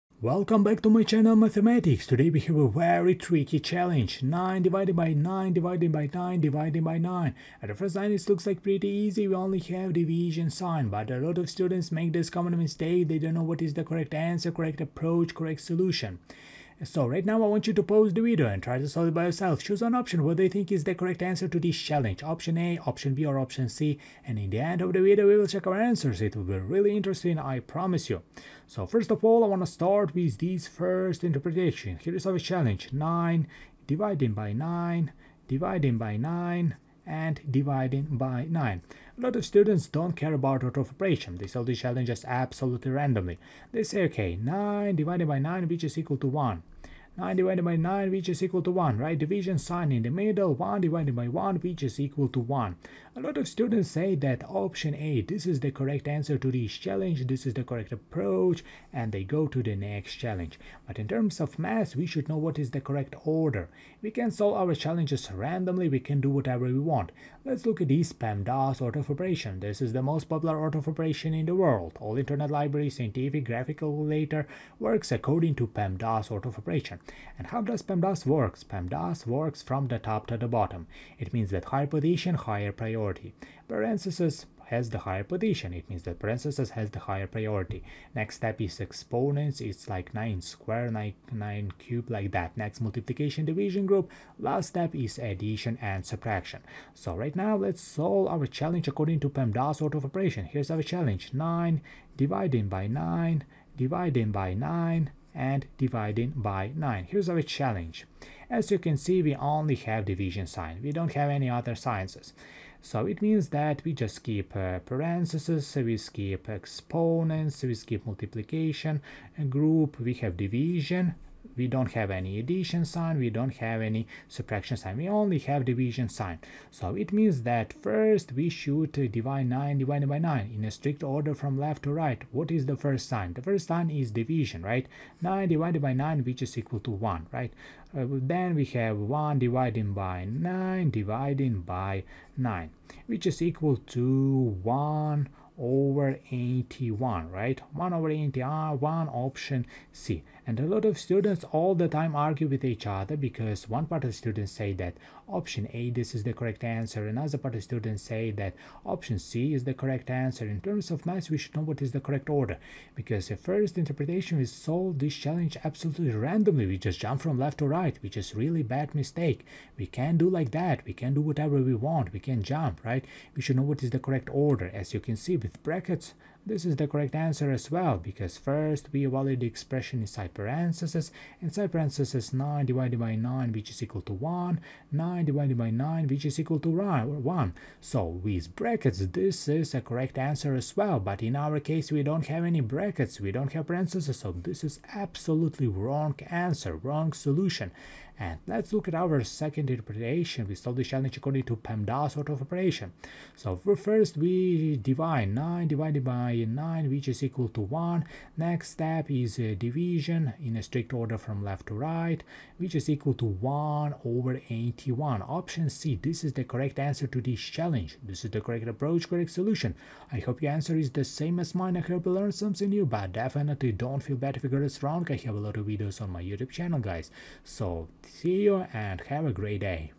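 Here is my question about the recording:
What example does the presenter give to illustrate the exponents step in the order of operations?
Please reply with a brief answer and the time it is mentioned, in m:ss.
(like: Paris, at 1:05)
9 squared, at 1:30.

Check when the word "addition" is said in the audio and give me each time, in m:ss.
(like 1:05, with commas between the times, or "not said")
1:35, 2:02.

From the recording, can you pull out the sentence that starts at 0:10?
But a lot of students make this common mistake, they don't know what is the correct answer, correct approach, correct solution.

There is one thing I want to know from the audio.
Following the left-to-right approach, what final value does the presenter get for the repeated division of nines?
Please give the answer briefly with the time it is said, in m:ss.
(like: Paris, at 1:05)
1/81, at 2:27.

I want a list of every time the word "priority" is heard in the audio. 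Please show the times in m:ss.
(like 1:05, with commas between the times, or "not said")
1:22, 1:27.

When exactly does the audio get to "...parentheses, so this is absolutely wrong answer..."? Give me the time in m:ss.
3:13.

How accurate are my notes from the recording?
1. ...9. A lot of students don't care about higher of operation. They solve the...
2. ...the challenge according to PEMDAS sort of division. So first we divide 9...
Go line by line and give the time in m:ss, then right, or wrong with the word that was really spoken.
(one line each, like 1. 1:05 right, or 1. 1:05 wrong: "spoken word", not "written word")
1. 0:38 wrong: "order", not "higher"
2. 3:20 wrong: "operation", not "division".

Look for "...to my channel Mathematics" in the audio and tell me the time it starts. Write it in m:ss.
0:00.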